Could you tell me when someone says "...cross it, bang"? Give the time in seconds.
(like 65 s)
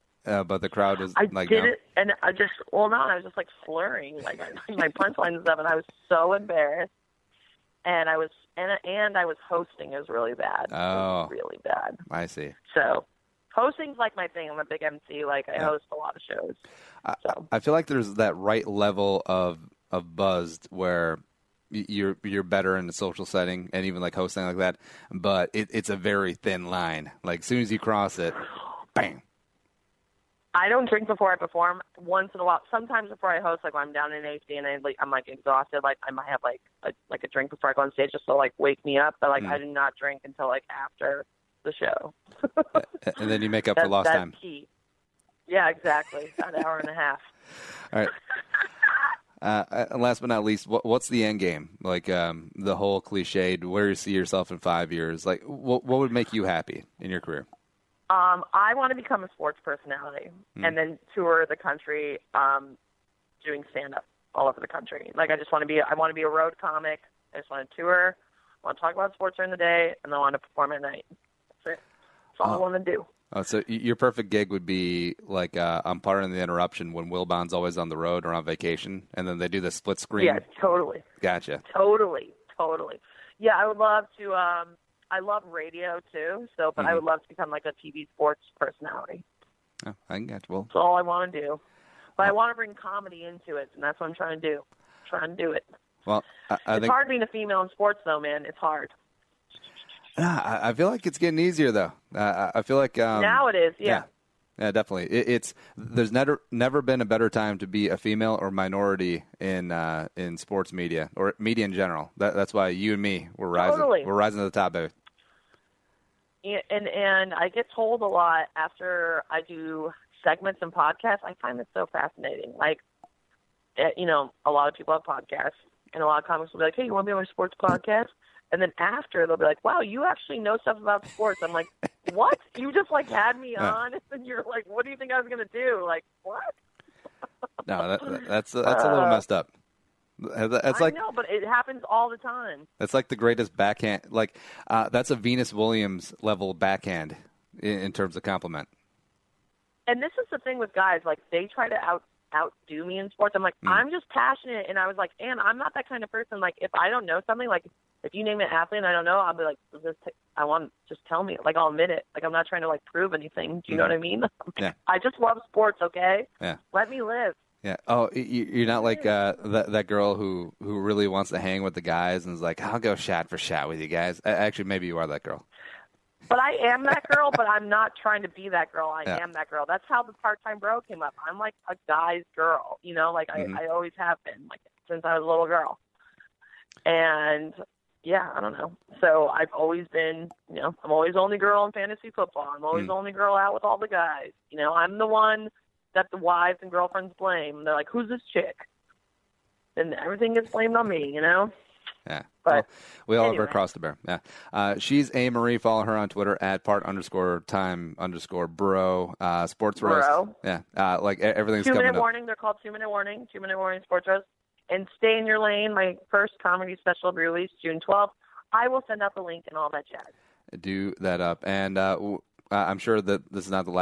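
27 s.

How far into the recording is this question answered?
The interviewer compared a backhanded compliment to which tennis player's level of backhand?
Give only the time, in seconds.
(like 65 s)
145 s.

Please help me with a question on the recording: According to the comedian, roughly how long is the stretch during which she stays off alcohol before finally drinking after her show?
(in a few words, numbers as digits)
An hour and a half.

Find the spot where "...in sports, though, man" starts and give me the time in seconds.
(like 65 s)
97 s.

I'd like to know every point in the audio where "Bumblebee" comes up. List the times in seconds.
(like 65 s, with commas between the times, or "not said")
not said.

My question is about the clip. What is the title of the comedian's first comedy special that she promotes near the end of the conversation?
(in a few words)
Stay in Your Lane.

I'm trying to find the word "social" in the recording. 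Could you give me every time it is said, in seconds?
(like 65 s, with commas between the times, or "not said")
22 s.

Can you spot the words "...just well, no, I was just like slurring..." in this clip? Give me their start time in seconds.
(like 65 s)
2 s.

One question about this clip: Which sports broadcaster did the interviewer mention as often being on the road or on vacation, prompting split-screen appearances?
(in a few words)
Wilbon.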